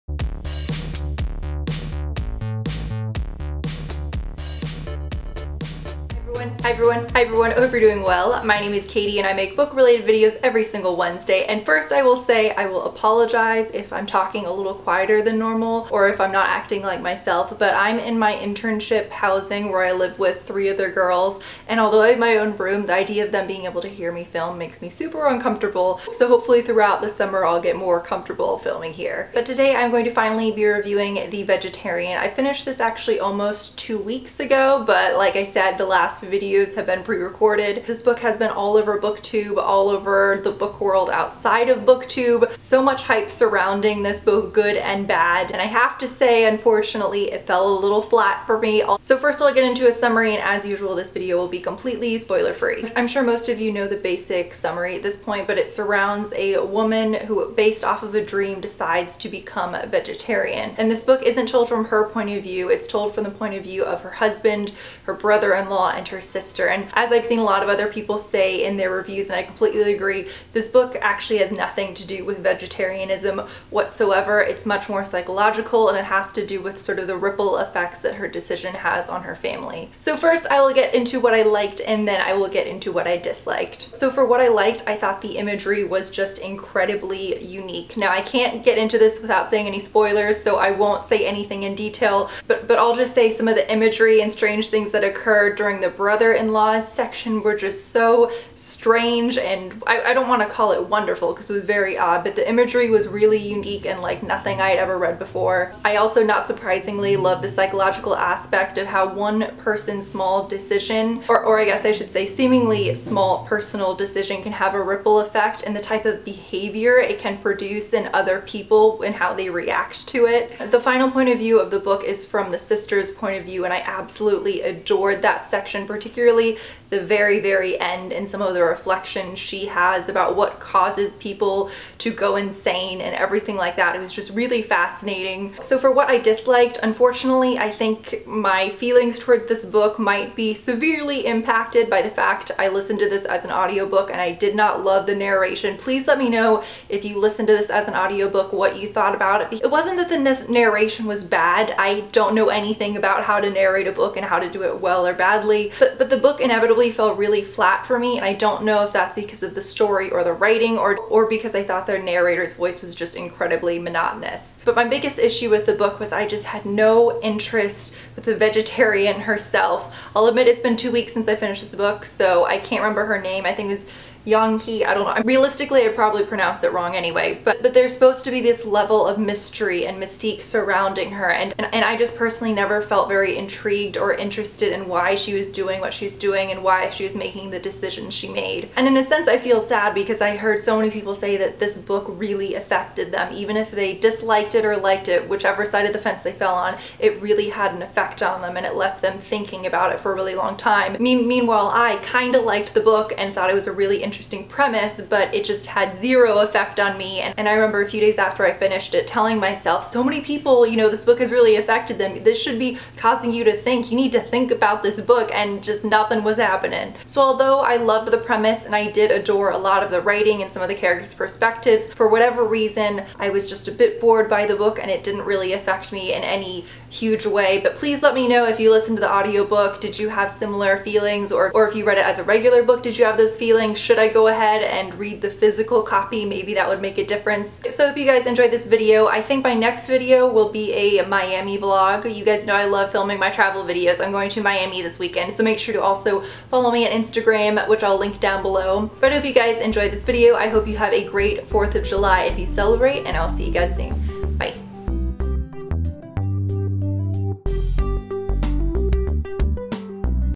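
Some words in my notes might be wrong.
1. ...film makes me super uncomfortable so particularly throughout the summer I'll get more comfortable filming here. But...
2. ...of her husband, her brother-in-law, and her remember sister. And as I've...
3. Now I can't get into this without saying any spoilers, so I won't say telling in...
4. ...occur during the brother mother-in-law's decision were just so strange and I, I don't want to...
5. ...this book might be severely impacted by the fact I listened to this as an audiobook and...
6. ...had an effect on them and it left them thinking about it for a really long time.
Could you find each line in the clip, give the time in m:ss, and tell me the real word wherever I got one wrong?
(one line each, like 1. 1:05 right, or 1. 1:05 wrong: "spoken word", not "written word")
1. 0:24 wrong: "hopefully", not "particularly"
2. 1:03 wrong: "sister", not "remember"
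3. 1:27 wrong: "anything", not "telling"
4. 1:35 wrong: "section", not "decision"
5. 2:19 right
6. 3:17 right.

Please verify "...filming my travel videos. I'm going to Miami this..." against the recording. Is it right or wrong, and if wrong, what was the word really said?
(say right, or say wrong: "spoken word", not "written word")
right.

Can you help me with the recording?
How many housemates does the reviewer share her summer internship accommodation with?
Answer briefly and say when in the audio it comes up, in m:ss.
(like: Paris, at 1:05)
3, at 0:20.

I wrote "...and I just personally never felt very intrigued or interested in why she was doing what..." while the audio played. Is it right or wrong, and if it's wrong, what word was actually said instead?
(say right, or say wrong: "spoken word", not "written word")
right.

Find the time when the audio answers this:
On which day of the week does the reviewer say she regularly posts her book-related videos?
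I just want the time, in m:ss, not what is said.
0:10.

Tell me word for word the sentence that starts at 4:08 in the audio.
But if you guys enjoyed this video.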